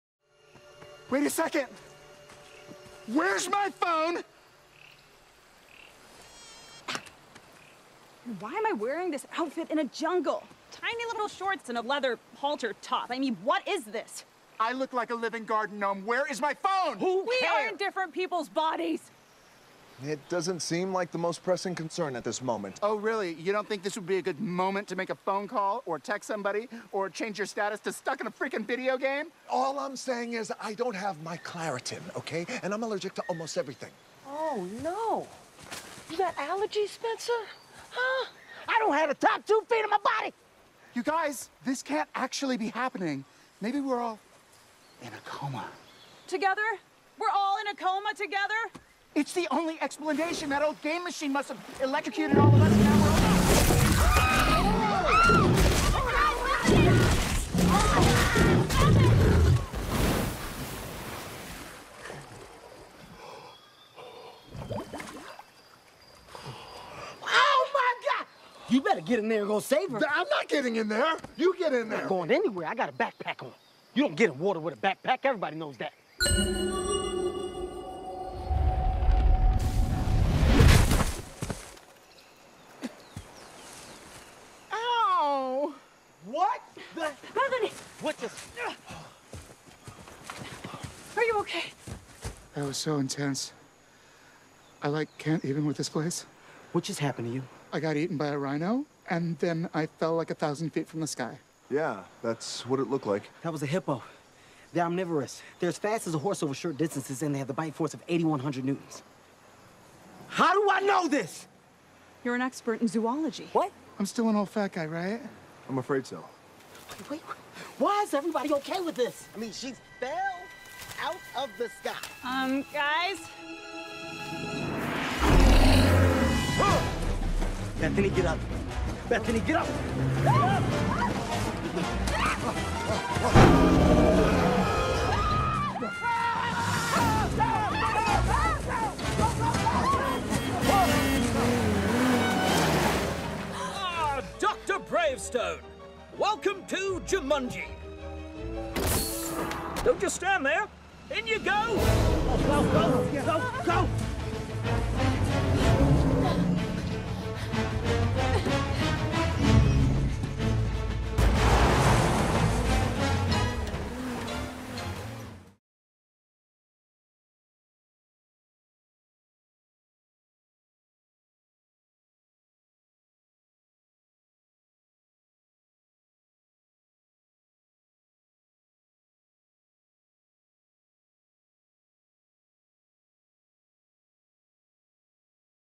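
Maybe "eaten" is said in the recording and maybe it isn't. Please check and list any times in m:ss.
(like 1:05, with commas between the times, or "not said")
1:37.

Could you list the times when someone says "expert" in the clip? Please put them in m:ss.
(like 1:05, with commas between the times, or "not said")
1:52.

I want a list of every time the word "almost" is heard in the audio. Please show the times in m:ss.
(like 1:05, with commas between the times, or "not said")
0:33.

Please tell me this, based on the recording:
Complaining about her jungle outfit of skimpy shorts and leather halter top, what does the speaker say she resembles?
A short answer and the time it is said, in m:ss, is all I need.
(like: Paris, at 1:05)
garden gnome, at 0:15.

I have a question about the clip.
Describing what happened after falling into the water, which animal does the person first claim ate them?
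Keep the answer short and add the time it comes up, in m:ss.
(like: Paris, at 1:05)
rhino, at 1:38.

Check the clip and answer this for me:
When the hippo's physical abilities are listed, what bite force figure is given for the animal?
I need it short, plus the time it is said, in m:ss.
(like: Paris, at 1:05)
8,100 newtons, at 1:48.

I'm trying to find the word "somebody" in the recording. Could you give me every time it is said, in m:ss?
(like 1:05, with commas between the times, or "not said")
0:26.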